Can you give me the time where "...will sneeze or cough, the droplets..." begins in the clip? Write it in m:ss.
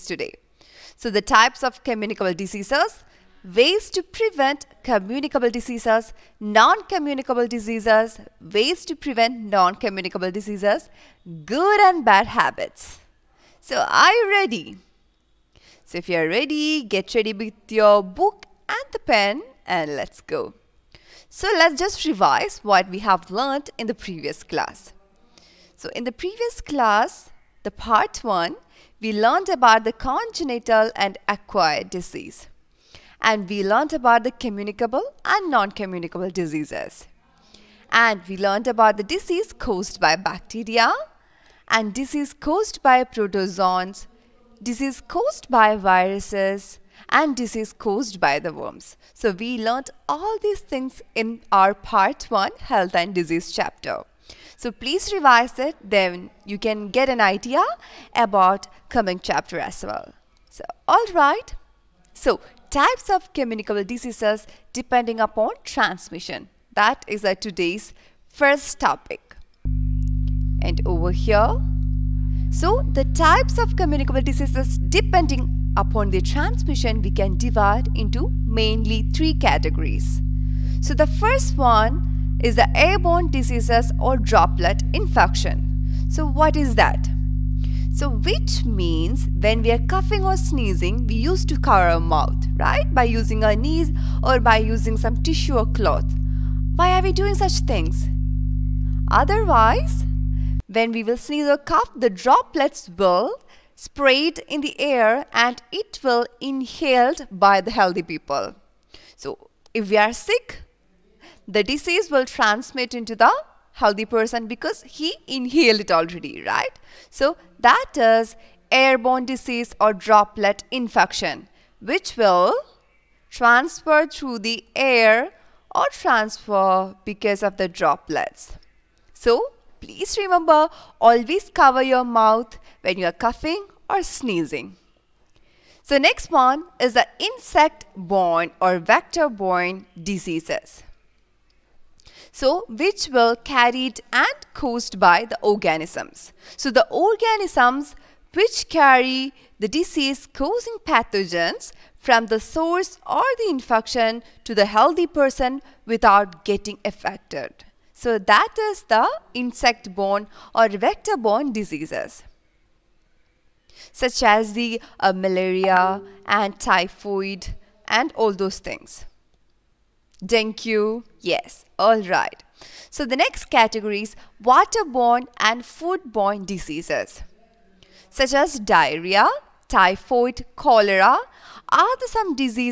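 1:41.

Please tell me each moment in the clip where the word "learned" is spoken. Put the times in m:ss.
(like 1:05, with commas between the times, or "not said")
0:23, 0:29, 0:33, 0:38, 0:49.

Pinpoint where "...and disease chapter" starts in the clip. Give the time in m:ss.
0:52.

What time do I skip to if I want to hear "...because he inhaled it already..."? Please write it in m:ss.
1:54.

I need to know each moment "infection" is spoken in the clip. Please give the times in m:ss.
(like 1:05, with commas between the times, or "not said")
1:24, 2:00, 2:33.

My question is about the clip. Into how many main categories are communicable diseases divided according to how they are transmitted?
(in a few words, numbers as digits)
3.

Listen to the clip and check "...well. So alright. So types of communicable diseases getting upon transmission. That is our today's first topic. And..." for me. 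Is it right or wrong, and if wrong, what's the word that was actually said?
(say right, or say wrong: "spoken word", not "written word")
wrong: "depending", not "getting".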